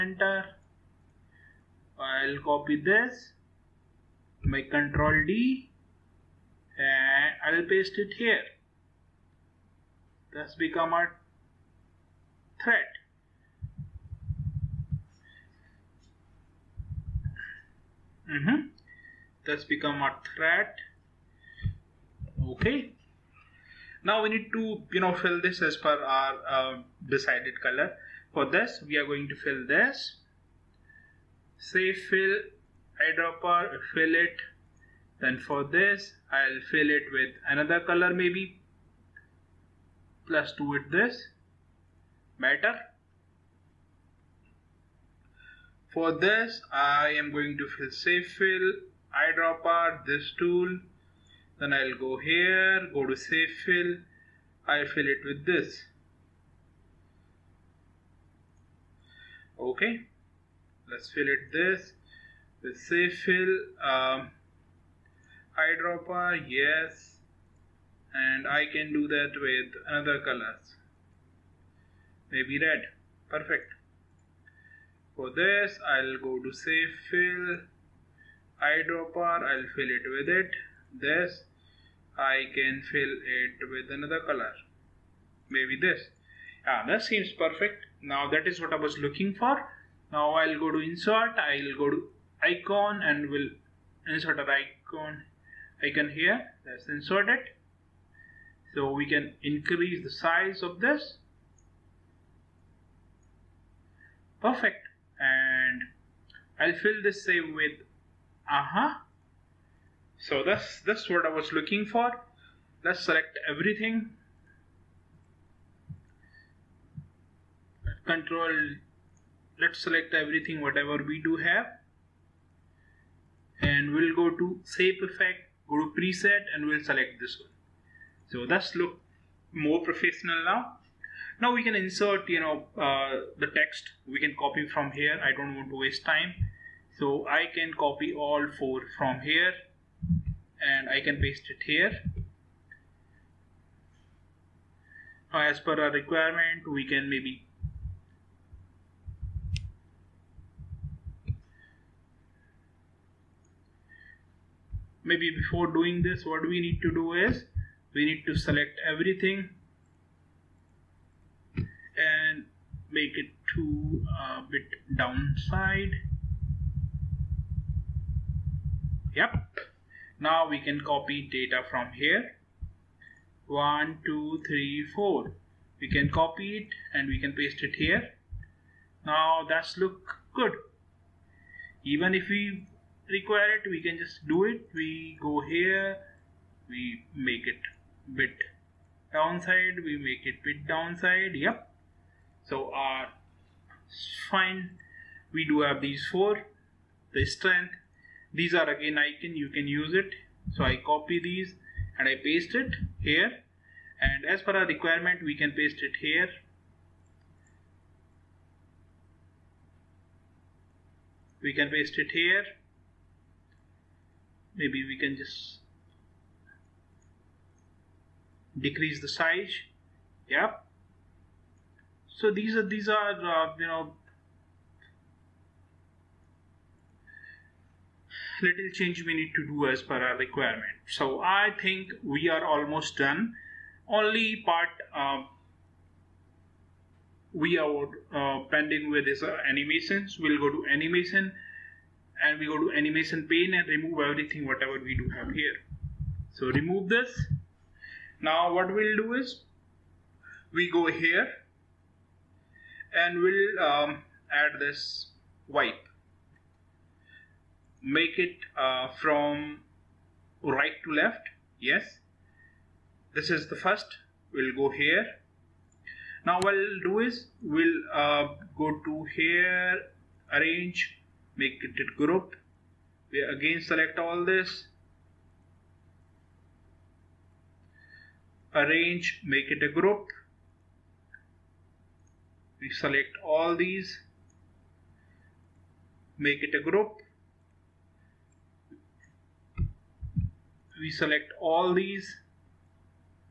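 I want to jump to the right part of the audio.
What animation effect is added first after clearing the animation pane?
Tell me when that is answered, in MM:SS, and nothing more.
04:15.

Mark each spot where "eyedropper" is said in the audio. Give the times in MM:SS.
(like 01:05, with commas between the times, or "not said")
00:33, 00:49, 01:05, 01:18.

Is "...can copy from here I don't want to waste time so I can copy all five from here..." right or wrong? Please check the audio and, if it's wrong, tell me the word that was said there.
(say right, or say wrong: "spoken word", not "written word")
wrong: "four", not "five".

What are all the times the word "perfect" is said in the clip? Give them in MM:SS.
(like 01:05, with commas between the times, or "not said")
01:13, 01:27, 01:44.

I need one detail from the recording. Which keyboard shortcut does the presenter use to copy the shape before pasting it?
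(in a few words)
Control D.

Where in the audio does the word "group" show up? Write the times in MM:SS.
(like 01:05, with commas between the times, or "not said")
04:32, 04:39, 04:46.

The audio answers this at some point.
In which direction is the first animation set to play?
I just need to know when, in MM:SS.
04:20.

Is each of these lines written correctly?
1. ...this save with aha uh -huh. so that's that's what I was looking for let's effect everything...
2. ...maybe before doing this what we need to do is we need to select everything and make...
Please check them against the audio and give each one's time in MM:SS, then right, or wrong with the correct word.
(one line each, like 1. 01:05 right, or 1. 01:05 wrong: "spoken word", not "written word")
1. 01:47 wrong: "select", not "effect"
2. 02:35 right.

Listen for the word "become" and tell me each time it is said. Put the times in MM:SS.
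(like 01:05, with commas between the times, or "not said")
00:10, 00:19.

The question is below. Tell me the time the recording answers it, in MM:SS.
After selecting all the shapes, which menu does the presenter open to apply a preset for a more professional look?
02:04.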